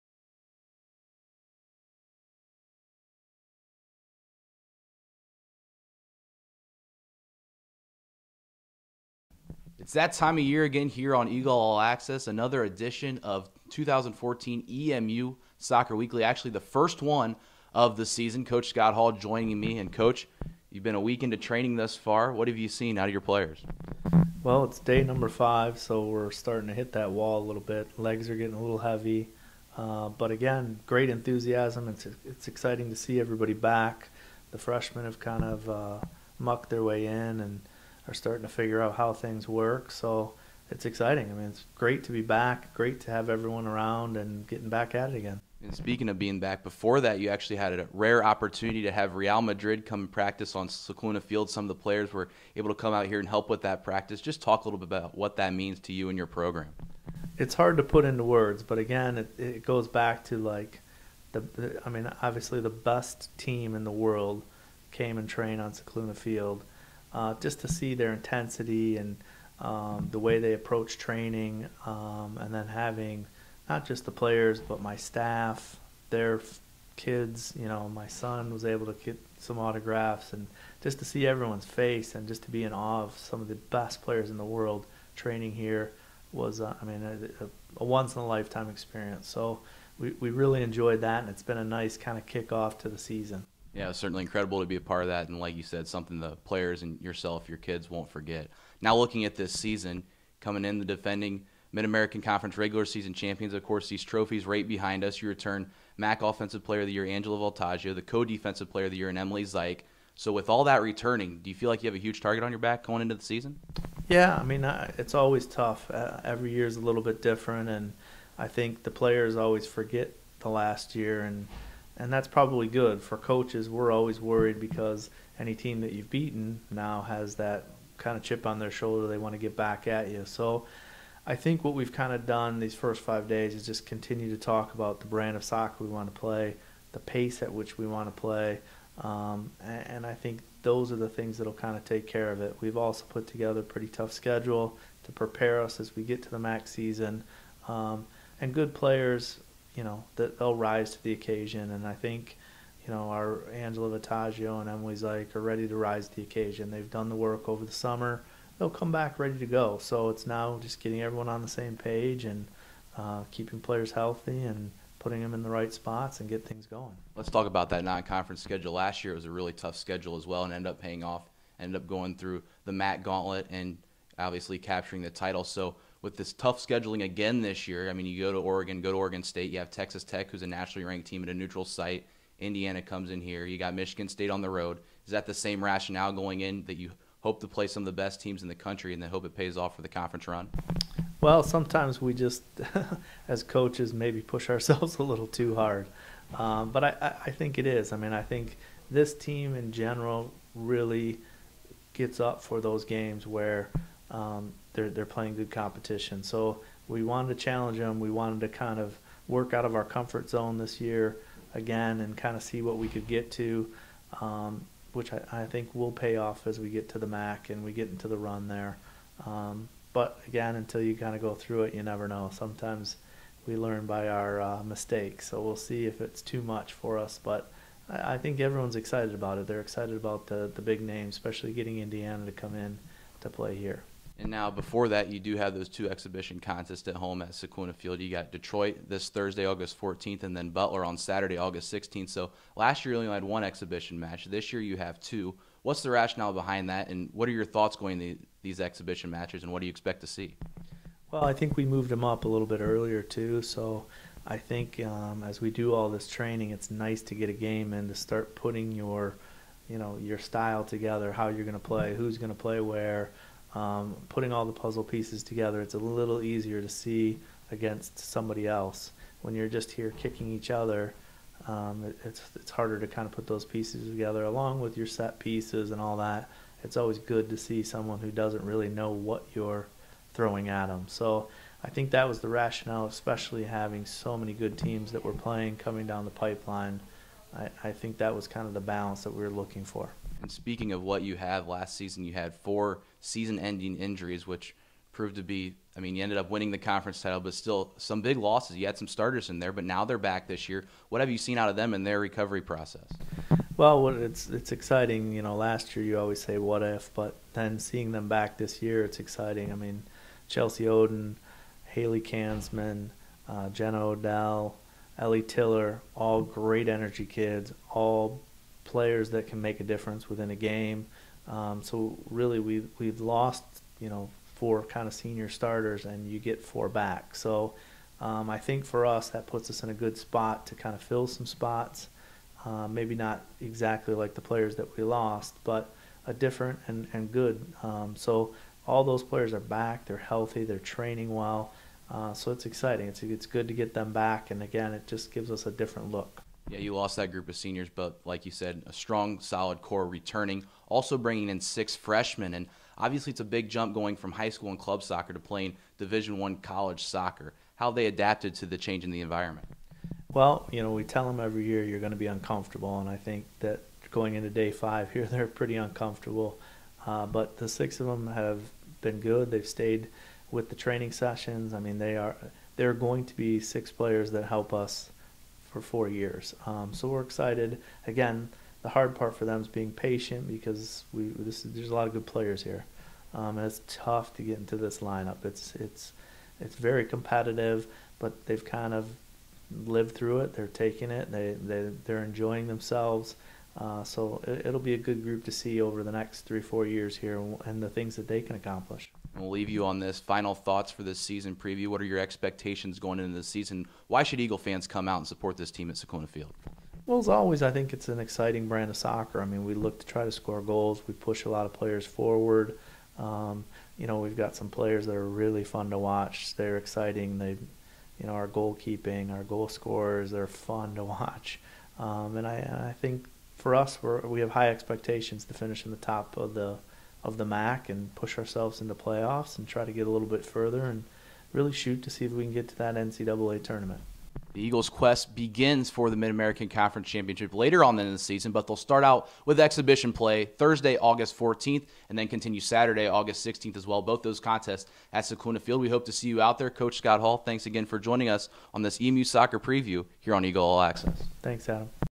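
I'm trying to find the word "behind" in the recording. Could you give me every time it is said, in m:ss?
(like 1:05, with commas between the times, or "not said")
1:44, 4:06.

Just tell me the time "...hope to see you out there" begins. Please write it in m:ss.
7:25.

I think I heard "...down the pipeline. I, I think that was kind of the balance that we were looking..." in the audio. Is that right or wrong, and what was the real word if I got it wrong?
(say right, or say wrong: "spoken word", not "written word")
right.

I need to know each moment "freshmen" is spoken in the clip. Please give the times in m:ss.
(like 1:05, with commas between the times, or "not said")
0:34, 5:51.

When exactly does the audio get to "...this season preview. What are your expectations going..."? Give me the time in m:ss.
6:40.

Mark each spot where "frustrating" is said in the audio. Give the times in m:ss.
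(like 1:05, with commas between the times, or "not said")
not said.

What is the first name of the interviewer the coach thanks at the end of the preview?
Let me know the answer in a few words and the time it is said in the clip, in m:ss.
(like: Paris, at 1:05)
Adam, at 7:31.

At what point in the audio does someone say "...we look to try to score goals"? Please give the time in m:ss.
6:49.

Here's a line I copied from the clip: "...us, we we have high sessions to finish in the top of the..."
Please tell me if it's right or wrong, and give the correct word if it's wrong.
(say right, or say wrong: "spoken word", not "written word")
wrong: "expectations", not "sessions".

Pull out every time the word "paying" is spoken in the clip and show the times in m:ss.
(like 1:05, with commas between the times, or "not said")
2:50.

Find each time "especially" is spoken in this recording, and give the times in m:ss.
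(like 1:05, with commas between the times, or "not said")
3:51, 4:42.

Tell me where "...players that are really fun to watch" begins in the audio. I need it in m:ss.
6:54.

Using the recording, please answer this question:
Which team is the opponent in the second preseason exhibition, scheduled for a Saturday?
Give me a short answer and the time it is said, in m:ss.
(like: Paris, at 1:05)
Butler, at 4:00.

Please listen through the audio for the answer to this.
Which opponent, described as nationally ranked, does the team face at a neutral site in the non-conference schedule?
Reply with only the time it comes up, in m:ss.
2:59.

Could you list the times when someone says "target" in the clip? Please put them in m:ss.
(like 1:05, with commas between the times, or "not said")
1:52.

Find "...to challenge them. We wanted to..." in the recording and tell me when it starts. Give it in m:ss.
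3:27.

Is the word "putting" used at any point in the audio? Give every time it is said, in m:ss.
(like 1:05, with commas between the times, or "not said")
2:44, 4:18, 4:24.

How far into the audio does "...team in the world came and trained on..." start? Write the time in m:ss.
1:03.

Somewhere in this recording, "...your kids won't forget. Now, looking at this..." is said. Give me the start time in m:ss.
1:37.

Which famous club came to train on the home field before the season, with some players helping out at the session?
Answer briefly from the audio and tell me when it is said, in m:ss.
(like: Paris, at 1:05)
Real Madrid, at 0:49.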